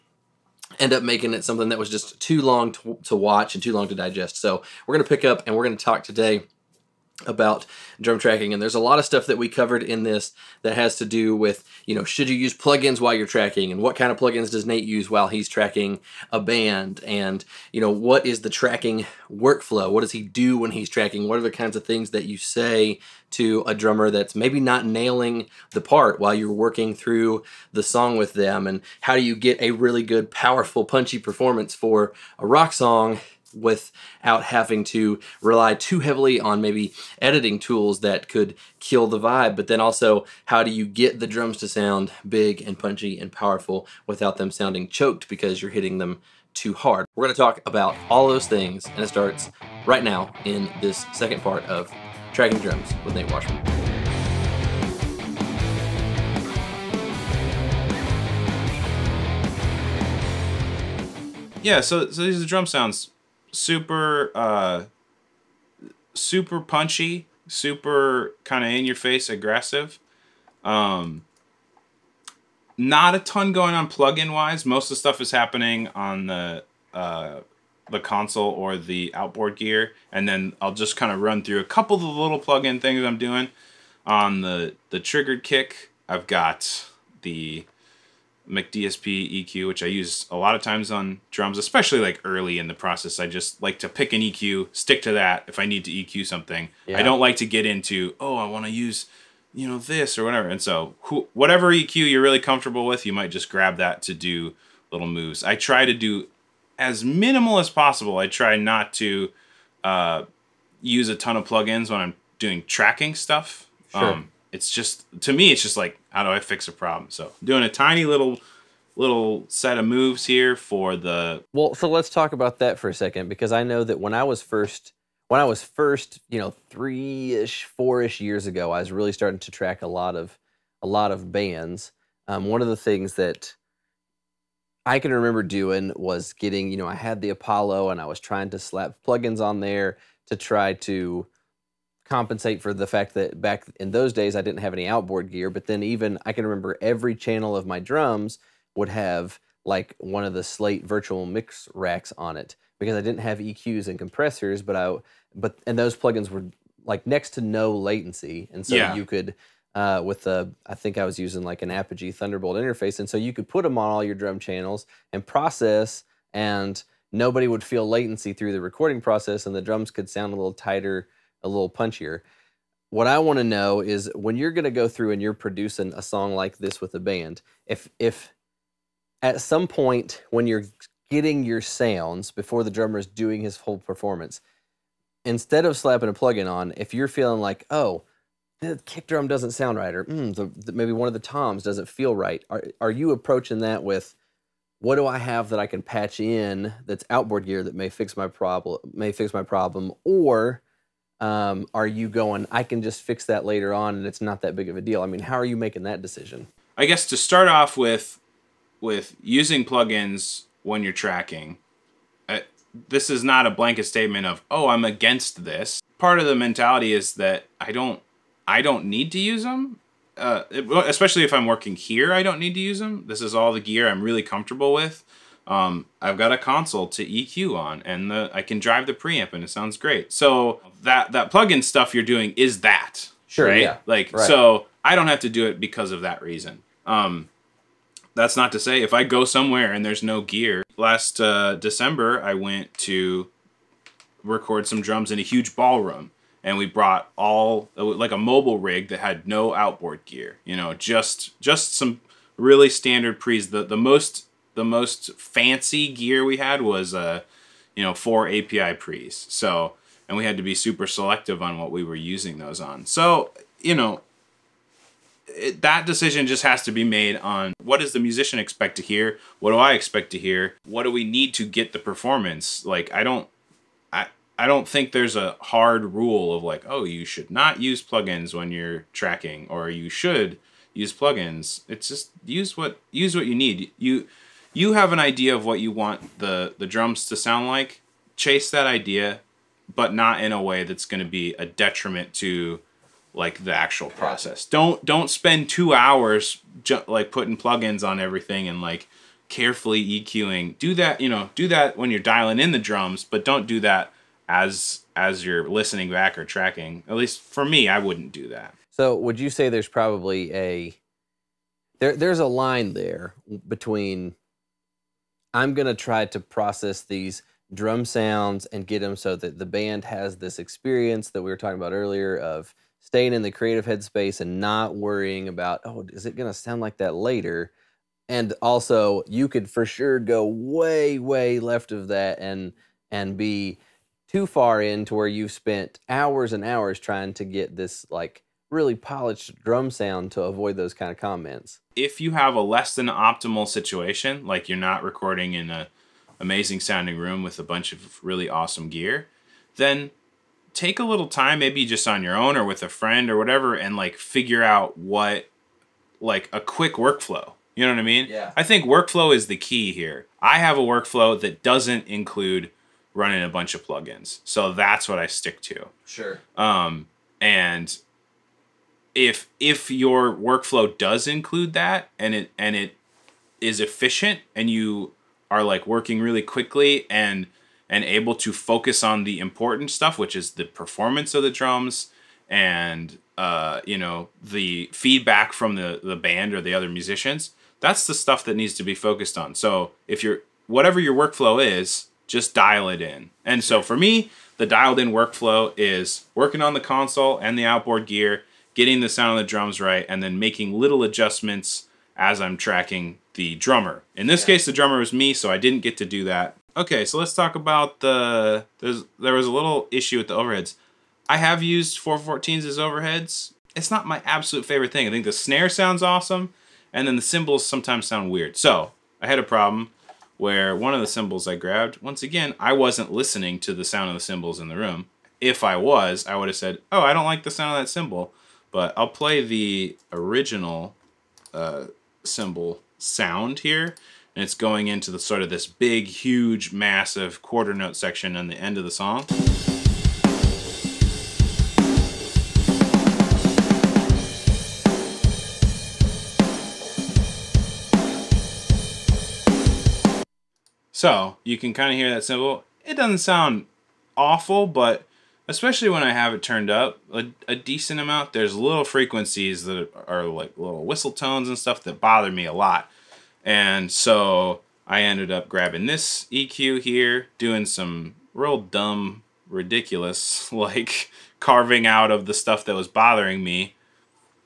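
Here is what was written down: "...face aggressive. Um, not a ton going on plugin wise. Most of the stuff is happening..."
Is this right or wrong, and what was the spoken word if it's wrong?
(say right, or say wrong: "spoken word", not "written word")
right.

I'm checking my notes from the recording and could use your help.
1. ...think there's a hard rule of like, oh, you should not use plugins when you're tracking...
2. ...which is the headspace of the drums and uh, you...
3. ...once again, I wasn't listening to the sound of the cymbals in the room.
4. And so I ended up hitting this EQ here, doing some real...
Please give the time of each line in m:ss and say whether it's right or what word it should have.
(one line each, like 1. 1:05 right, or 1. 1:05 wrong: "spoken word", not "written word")
1. 4:34 right
2. 6:19 wrong: "performance", not "headspace"
3. 7:01 right
4. 7:43 wrong: "grabbing", not "hitting".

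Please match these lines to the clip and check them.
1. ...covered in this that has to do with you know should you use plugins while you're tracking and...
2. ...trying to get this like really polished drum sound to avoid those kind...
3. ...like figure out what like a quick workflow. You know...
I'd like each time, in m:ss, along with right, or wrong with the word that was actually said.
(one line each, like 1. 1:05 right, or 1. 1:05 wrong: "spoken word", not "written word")
1. 0:09 right
2. 5:36 right
3. 5:53 right.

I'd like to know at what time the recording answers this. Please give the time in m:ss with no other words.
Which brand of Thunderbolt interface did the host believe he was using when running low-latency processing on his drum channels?
2:41.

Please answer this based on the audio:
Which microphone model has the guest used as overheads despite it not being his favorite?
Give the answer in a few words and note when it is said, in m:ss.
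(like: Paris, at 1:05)
414, at 6:51.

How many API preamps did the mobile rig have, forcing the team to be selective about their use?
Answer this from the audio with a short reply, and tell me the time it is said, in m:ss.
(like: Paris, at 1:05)
4, at 4:17.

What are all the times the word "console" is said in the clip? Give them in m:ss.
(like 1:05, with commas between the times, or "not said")
1:18, 3:46, 6:36.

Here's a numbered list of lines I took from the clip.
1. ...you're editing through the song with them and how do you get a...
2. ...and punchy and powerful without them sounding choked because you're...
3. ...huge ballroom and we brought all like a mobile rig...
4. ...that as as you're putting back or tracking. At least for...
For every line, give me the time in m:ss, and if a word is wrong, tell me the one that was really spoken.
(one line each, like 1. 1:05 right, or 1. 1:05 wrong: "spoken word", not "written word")
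1. 0:26 wrong: "working", not "editing"
2. 0:42 right
3. 4:05 right
4. 5:03 wrong: "listening", not "putting".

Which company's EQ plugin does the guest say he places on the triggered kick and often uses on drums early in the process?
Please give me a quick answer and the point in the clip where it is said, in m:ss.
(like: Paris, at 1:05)
McDSP, at 1:28.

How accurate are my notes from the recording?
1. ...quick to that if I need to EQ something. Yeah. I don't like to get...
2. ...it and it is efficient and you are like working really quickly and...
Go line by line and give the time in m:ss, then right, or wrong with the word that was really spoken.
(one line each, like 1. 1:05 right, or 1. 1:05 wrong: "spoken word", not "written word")
1. 1:34 wrong: "stick", not "quick"
2. 6:12 right.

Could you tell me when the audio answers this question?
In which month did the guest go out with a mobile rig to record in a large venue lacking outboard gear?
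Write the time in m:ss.
4:01.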